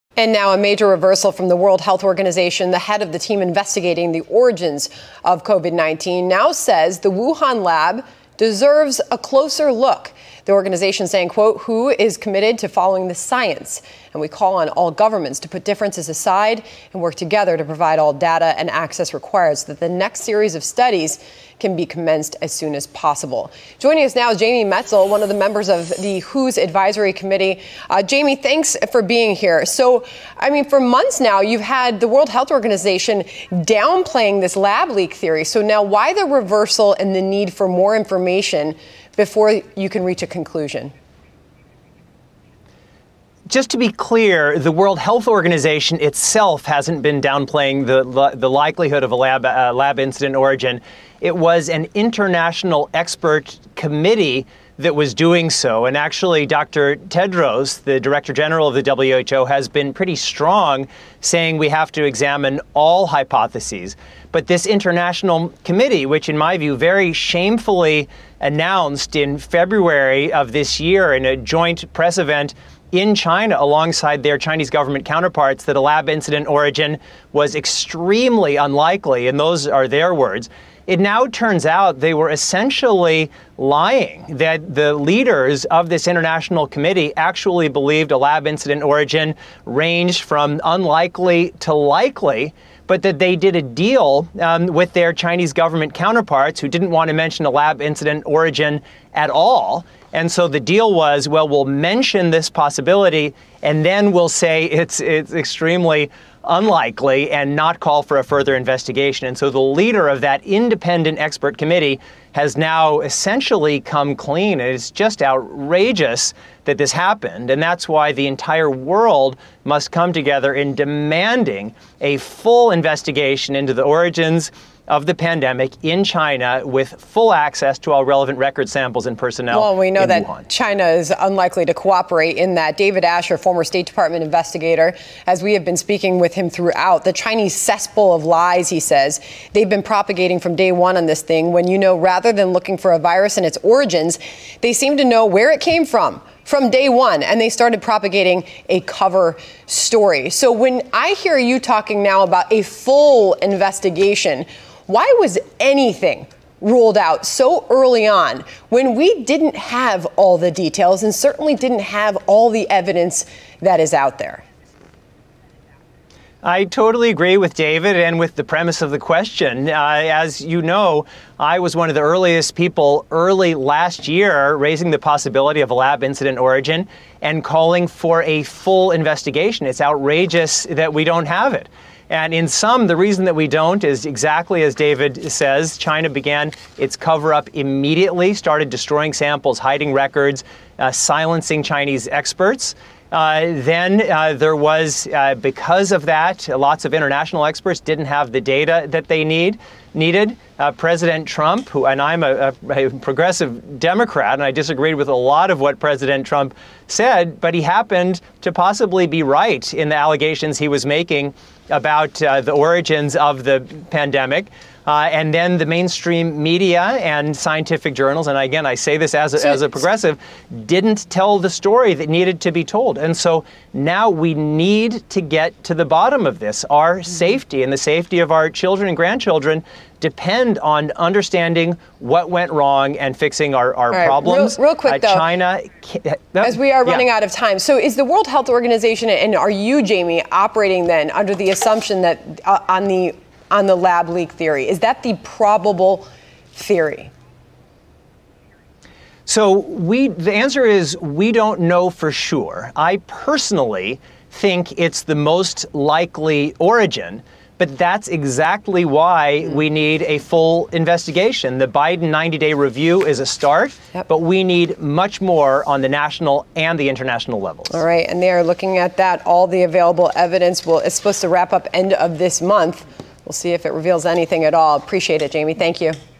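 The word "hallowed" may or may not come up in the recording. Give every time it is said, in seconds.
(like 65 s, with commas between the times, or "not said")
not said.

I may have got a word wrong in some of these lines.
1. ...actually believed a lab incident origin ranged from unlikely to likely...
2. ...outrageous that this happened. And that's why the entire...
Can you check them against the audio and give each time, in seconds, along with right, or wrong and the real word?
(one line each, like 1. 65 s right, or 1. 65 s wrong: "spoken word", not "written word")
1. 87 s right
2. 115 s right.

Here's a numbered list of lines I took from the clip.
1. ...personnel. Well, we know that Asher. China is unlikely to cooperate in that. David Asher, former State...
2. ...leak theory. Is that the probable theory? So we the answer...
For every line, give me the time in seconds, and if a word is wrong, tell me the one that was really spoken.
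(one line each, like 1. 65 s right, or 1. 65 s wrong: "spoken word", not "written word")
1. 129 s wrong: "Wuhan", not "Asher"
2. 244 s right.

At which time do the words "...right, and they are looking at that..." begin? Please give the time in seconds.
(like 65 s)
267 s.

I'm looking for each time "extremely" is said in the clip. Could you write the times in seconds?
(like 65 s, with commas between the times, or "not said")
77 s, 105 s.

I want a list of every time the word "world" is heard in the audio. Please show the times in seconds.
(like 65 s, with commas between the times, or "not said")
1 s, 32 s, 44 s, 118 s, 238 s.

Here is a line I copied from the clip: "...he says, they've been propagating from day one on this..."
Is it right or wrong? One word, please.
right.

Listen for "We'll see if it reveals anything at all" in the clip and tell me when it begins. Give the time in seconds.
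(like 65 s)
273 s.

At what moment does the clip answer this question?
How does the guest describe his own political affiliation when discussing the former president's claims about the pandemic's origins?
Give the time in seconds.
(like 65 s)
202 s.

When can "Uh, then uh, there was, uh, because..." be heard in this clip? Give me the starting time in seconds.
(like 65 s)
193 s.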